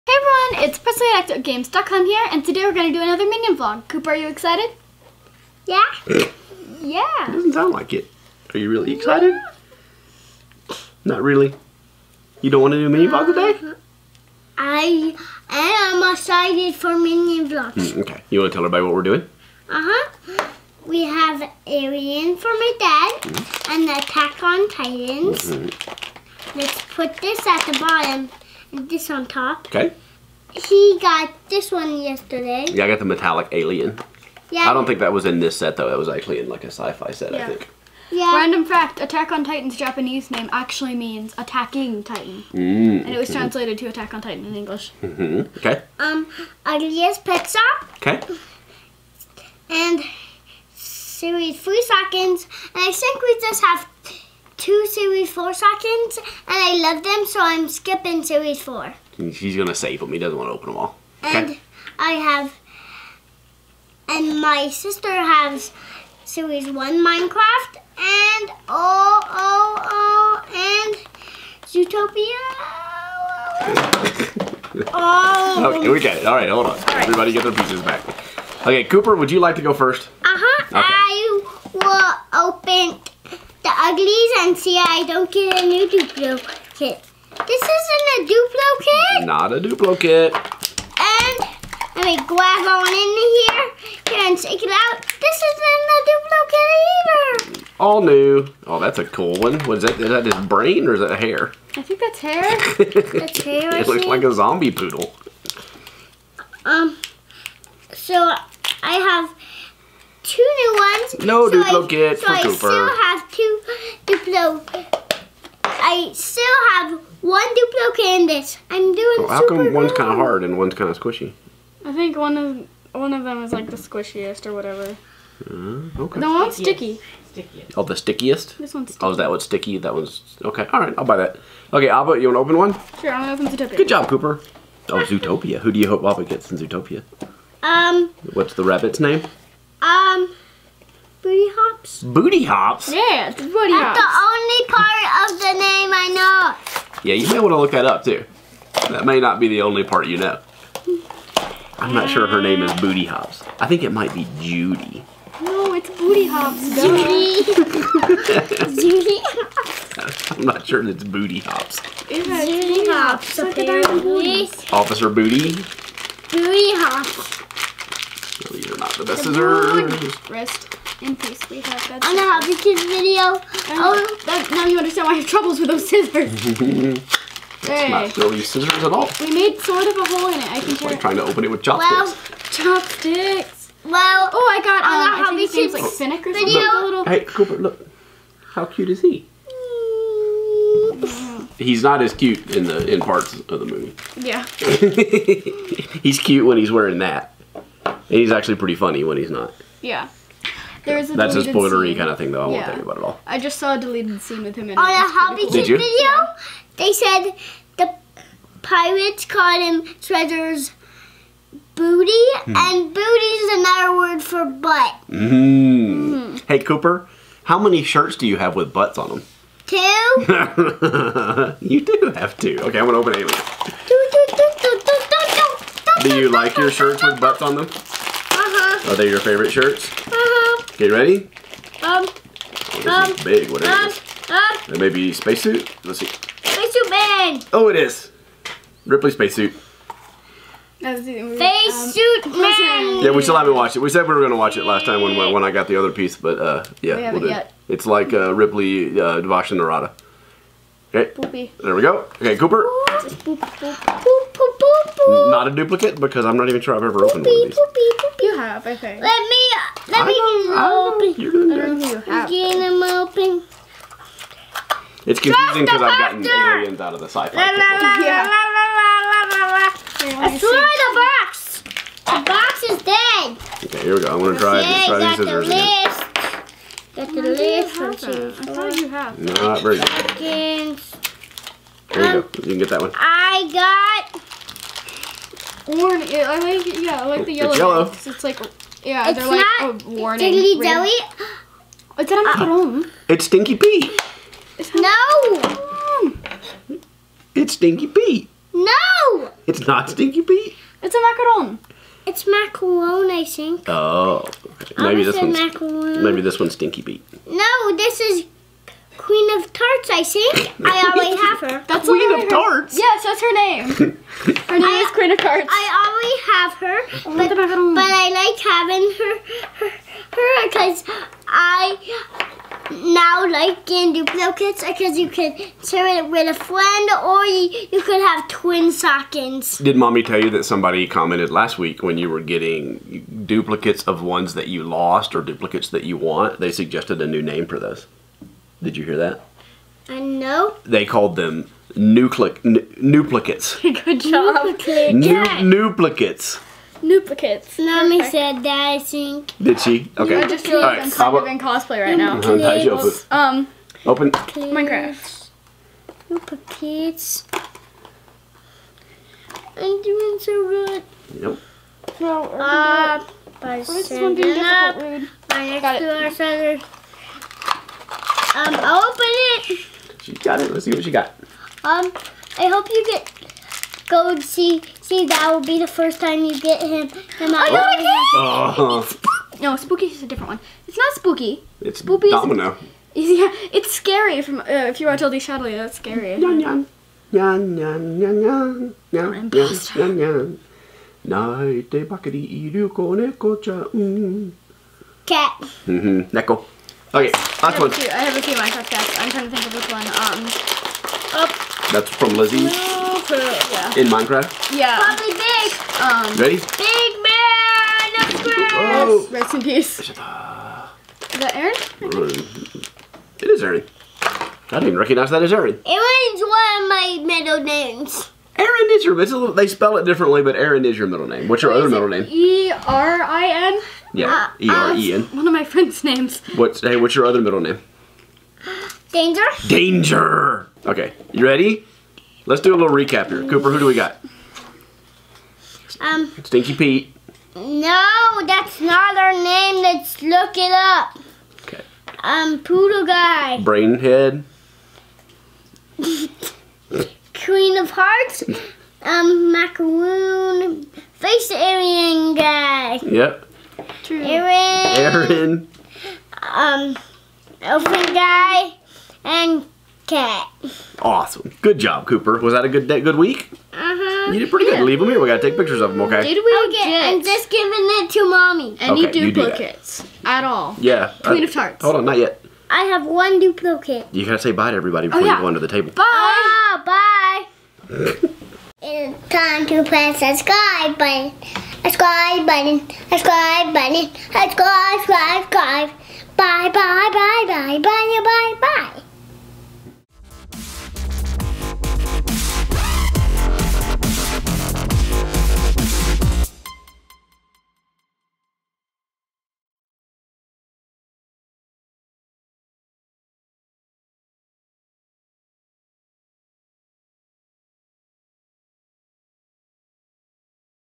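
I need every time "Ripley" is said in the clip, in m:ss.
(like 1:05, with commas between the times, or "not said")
3:58, 4:08.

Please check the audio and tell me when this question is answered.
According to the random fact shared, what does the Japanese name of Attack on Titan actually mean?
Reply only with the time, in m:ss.
0:41.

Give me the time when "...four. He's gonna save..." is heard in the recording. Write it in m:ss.
0:58.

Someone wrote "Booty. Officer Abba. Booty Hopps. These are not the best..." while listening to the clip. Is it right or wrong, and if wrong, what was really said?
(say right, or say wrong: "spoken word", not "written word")
wrong: "Booty", not "Abba".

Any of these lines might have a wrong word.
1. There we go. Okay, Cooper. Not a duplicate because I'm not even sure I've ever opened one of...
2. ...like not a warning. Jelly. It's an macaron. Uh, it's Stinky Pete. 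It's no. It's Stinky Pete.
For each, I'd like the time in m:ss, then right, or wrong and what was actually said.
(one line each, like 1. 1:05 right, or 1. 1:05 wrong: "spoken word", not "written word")
1. 4:11 right
2. 4:49 right.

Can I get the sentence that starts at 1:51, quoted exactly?
No so Duplo I, kit so for I Cooper.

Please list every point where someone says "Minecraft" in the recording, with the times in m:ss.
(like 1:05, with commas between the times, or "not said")
1:07, 5:54, 6:38, 6:43.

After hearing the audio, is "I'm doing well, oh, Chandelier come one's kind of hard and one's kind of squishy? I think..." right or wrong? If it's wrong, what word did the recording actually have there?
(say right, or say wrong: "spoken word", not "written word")
wrong: "How", not "Chandelier".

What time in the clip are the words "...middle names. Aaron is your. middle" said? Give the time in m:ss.
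6:57.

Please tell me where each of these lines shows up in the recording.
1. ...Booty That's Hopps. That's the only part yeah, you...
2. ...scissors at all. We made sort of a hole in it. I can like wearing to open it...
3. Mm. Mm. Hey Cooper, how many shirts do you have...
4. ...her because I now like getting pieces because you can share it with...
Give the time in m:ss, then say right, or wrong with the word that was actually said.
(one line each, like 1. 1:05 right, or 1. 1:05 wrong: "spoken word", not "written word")
1. 2:23 right
2. 2:58 wrong: "trying", not "wearing"
3. 3:35 right
4. 5:20 wrong: "duplicates", not "pieces".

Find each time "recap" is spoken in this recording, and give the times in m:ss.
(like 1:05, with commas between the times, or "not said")
7:12.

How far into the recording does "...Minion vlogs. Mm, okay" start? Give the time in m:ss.
0:16.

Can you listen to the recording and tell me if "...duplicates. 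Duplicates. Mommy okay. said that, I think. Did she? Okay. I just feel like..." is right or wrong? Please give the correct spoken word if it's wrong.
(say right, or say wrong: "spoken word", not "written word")
right.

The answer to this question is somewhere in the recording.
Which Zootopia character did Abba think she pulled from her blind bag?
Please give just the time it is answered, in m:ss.
3:05.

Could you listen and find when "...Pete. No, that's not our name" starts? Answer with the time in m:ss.
7:16.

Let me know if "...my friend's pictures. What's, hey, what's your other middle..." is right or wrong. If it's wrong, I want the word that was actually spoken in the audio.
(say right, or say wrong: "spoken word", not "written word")
wrong: "names", not "pictures".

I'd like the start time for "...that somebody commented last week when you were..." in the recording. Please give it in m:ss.
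5:30.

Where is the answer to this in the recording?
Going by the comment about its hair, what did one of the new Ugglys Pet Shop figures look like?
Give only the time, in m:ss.
1:44.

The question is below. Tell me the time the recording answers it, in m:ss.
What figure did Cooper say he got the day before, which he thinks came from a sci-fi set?
0:33.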